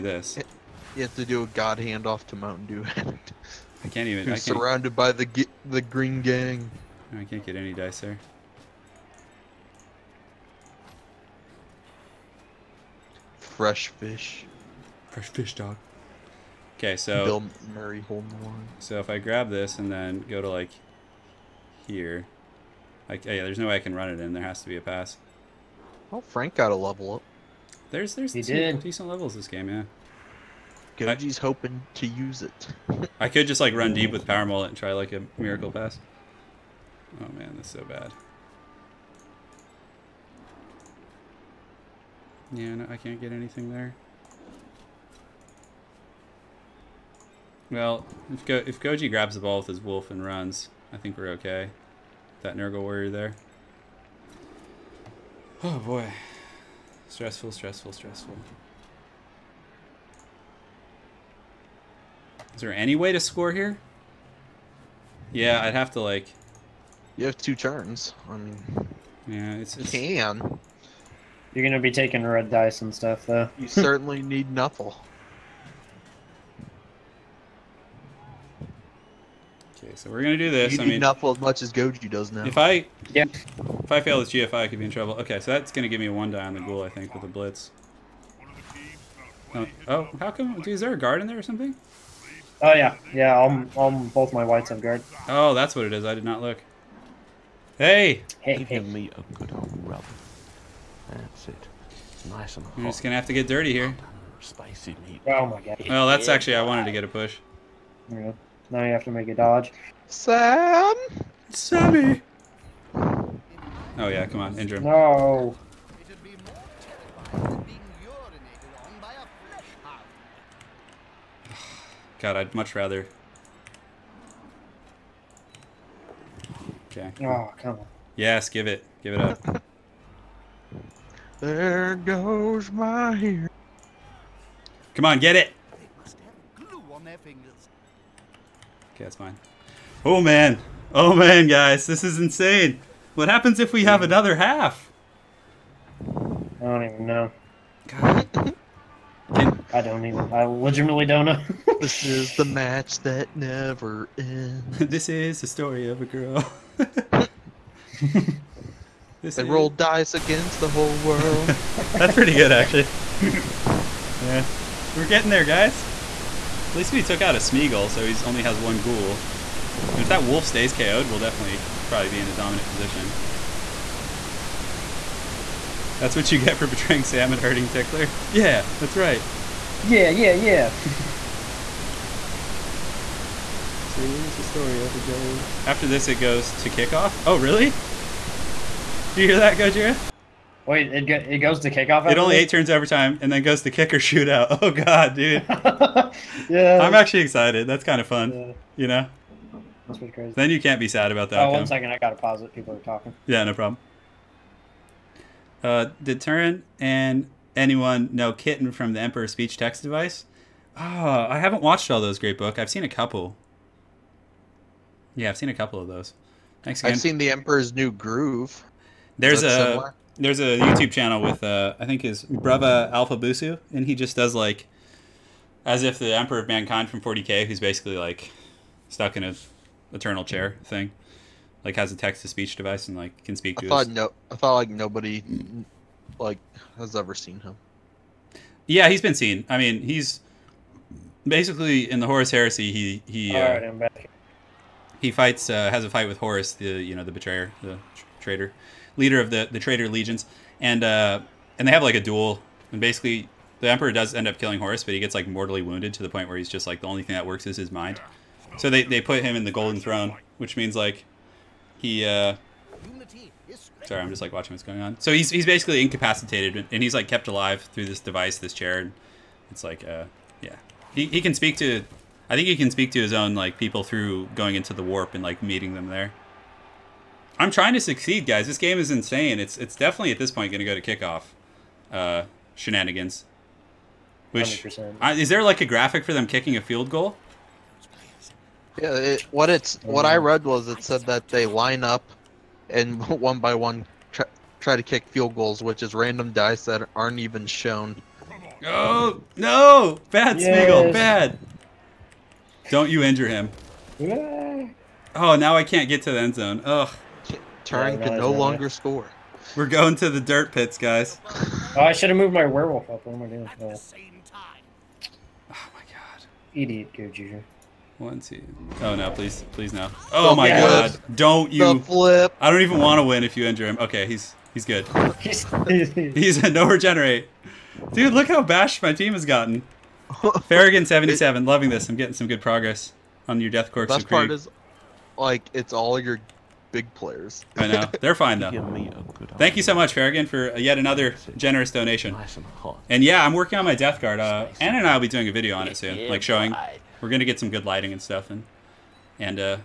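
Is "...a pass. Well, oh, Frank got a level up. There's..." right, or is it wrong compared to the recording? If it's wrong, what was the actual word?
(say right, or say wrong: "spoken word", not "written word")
right.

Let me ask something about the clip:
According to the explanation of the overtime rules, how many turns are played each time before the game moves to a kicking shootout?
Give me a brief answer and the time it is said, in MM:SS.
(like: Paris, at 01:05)
8, at 03:12.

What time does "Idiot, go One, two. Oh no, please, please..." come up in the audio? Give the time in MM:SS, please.
05:16.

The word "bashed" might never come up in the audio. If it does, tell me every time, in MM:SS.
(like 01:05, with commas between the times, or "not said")
05:28.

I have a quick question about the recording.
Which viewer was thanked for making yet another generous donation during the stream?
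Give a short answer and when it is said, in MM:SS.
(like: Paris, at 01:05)
Farragut 77, at 05:30.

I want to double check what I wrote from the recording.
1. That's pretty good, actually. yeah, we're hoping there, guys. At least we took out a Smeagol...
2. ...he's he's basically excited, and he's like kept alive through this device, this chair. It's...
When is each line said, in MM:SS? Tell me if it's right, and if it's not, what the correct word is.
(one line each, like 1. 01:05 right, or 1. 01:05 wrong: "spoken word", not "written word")
1. 02:41 wrong: "getting", not "hoping"
2. 04:25 wrong: "incapacitated", not "excited".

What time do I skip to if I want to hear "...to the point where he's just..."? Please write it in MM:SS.
04:15.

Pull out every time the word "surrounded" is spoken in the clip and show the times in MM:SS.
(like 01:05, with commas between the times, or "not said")
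00:04.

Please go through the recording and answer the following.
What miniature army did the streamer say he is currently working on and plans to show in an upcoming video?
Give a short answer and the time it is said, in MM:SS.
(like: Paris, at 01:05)
Death Guard, at 05:43.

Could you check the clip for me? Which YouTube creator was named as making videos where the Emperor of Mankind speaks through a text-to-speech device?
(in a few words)
Alfabusa.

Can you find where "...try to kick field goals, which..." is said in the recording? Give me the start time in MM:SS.
04:54.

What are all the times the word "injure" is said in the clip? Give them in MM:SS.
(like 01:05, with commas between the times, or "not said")
01:54, 05:03, 05:23.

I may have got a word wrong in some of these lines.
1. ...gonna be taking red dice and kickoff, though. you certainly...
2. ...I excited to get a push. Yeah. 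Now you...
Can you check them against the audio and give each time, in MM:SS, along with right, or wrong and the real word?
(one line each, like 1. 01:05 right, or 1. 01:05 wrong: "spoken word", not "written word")
1. 01:11 wrong: "stuff", not "kickoff"
2. 01:46 wrong: "wanted", not "excited".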